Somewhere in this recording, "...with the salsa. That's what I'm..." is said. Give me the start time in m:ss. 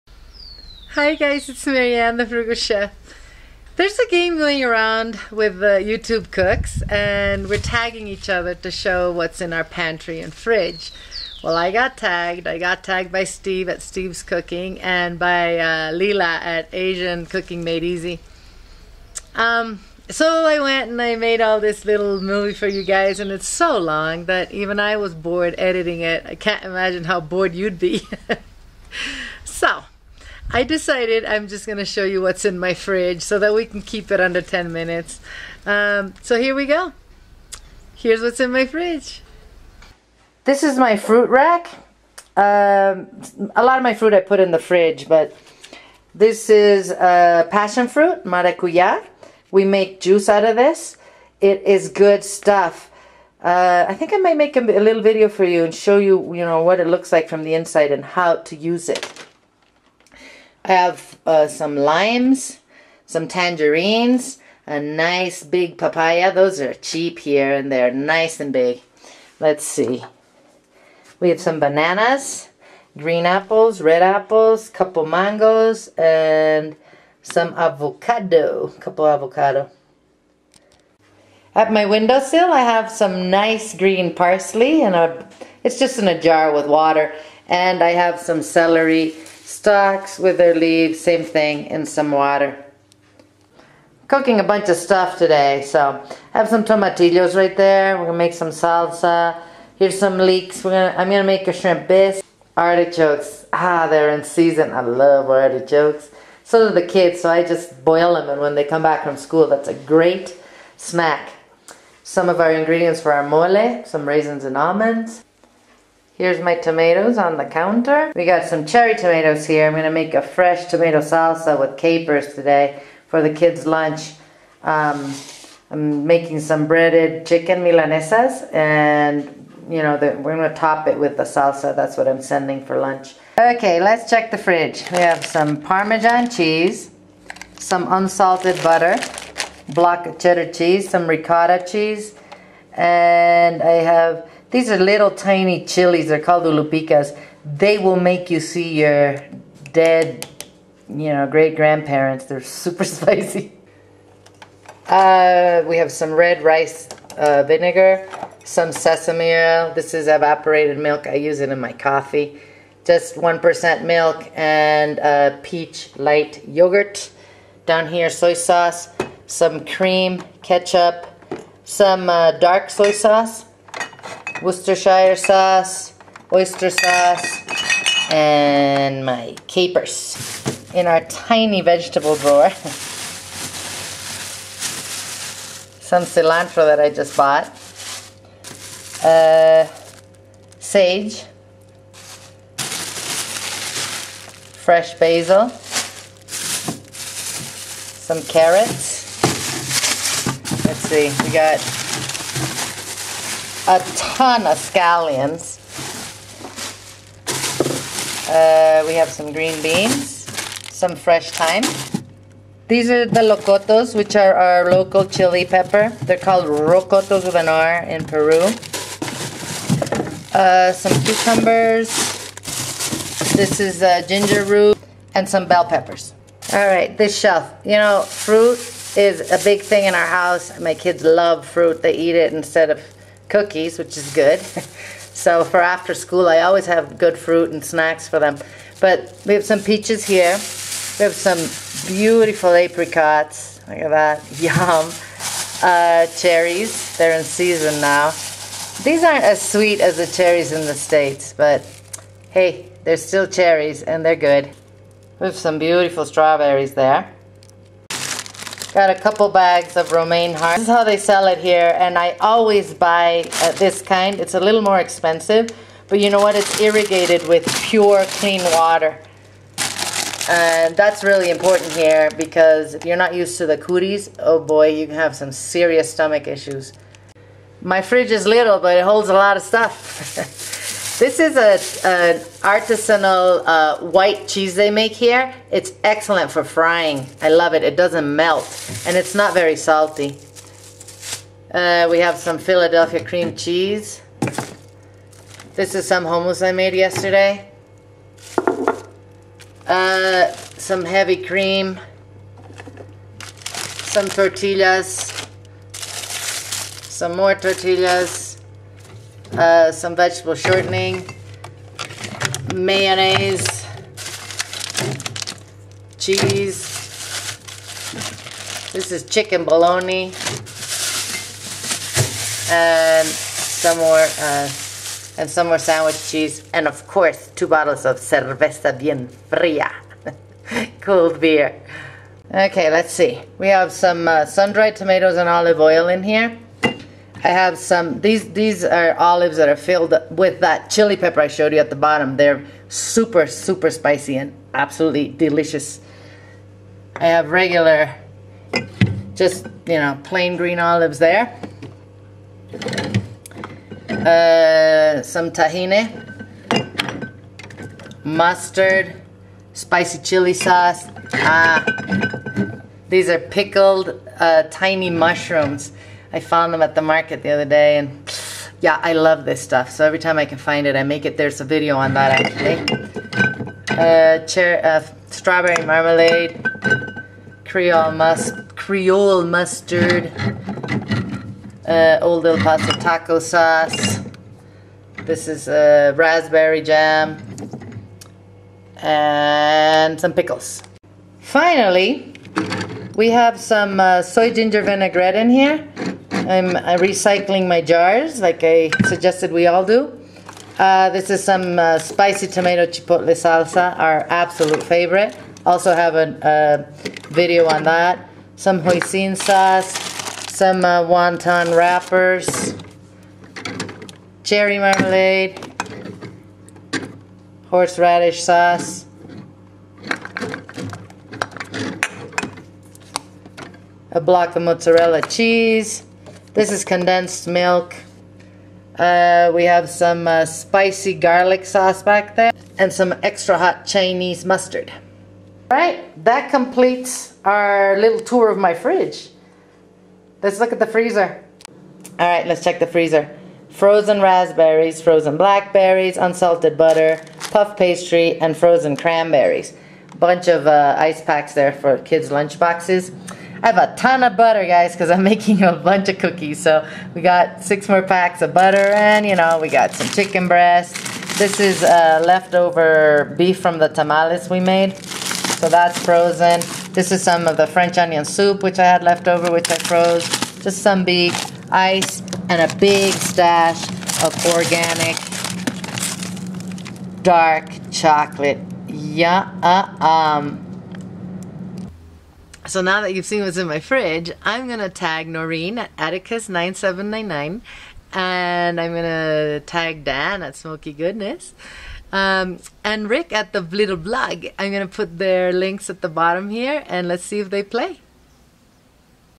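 2:10.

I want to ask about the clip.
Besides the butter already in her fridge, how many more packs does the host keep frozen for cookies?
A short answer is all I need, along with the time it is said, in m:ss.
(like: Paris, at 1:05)
6, at 7:37.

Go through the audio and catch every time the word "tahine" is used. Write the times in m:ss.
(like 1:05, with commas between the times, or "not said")
5:55.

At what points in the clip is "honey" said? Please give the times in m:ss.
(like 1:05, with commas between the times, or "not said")
not said.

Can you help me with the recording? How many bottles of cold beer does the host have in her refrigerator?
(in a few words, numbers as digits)
2.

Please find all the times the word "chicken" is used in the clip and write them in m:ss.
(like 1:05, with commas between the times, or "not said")
2:07, 5:19, 7:39.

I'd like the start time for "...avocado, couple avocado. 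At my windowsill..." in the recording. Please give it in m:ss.
1:17.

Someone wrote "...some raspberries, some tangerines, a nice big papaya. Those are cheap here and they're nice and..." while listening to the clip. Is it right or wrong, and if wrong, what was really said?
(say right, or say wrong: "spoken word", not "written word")
wrong: "limes", not "raspberries".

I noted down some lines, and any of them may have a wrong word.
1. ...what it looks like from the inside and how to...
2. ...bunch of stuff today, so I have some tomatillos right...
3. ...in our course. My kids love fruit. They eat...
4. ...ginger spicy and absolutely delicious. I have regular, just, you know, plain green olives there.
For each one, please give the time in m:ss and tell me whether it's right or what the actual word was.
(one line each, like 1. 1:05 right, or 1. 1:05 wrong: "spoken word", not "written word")
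1. 0:56 right
2. 1:34 right
3. 3:49 wrong: "house", not "course"
4. 5:43 wrong: "super", not "ginger".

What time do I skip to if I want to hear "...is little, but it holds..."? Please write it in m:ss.
4:38.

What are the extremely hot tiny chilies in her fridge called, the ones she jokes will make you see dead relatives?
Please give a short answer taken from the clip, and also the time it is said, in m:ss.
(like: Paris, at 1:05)
ulupicas, at 2:26.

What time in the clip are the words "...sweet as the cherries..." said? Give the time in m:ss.
4:09.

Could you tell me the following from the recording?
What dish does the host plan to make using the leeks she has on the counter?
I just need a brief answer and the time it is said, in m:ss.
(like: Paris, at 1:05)
shrimp bisque, at 1:41.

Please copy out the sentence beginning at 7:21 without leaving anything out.
All right, let's check the freezer.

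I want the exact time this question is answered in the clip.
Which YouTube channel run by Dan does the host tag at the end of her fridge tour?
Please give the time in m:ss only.
8:10.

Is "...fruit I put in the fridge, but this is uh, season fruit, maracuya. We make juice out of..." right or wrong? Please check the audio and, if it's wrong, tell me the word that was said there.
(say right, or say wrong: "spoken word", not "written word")
wrong: "passion", not "season".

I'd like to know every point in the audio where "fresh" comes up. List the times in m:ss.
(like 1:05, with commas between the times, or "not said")
2:00, 3:14, 3:30.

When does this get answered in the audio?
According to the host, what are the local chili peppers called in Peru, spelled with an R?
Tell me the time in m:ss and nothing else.
3:36.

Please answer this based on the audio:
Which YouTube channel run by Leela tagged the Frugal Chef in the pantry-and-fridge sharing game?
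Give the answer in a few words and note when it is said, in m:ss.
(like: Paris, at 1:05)
Asian Cooking Made Easy, at 0:16.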